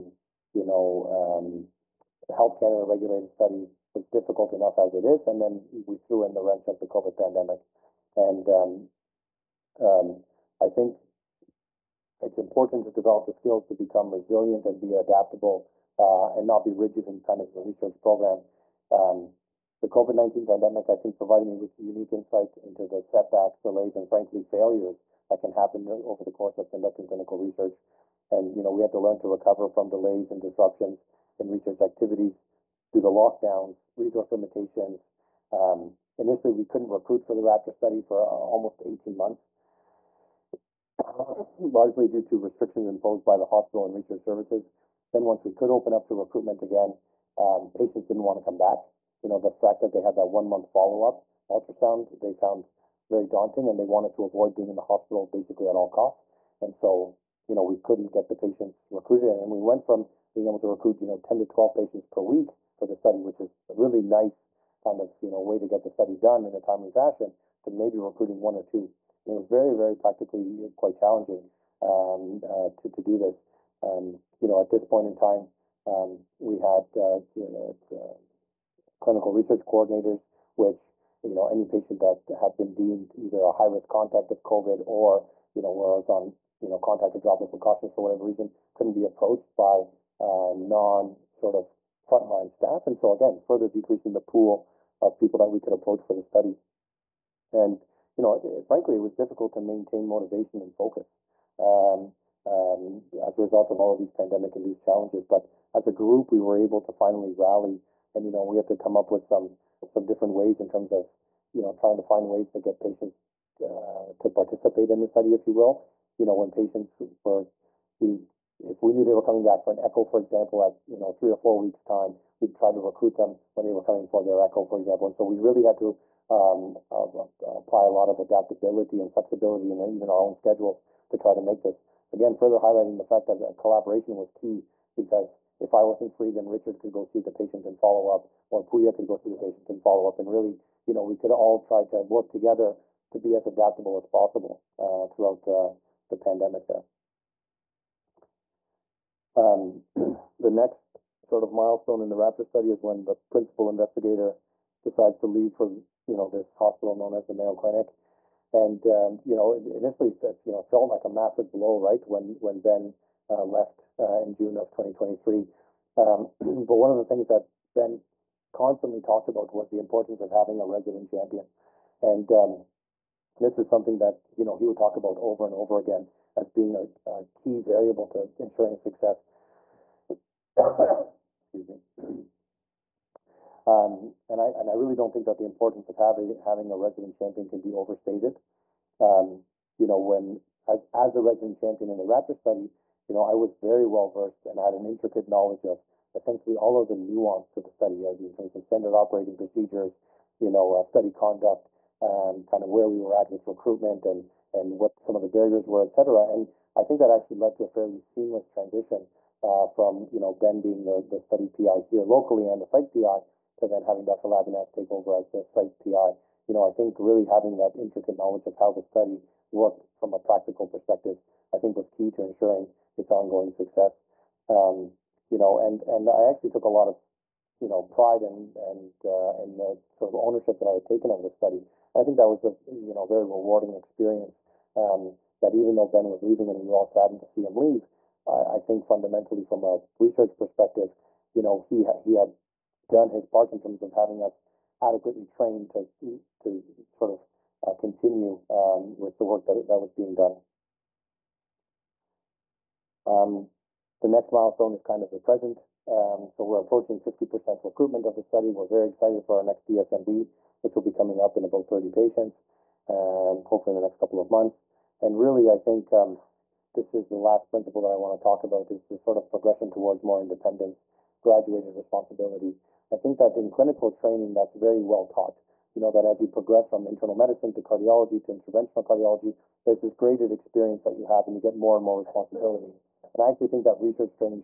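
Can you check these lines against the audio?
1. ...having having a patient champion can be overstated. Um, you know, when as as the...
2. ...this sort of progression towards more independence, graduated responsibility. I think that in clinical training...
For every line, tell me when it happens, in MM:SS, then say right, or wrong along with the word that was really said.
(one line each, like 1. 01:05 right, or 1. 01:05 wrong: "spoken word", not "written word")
1. 03:05 wrong: "resident", not "patient"
2. 04:28 right.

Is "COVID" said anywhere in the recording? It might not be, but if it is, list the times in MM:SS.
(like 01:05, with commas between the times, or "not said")
00:06, 00:19, 01:24.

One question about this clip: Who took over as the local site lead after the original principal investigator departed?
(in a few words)
Dr. Labinaz.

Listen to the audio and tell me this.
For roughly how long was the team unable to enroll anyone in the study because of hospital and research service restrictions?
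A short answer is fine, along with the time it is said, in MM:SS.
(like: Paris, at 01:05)
18 months, at 00:38.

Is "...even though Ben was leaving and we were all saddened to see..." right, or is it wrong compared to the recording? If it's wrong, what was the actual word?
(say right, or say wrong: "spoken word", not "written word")
right.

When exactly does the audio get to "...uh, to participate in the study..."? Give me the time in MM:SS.
01:53.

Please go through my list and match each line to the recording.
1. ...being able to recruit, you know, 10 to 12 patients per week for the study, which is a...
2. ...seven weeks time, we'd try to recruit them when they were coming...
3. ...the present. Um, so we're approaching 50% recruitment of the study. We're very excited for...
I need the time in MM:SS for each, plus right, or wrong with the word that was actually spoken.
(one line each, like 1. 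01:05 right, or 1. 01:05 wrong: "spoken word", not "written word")
1. 01:00 right
2. 02:01 wrong: "four", not "seven"
3. 04:15 right.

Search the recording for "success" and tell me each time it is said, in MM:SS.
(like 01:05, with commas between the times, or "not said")
02:58, 03:43.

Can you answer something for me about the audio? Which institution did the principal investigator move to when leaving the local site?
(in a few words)
Mayo Clinic.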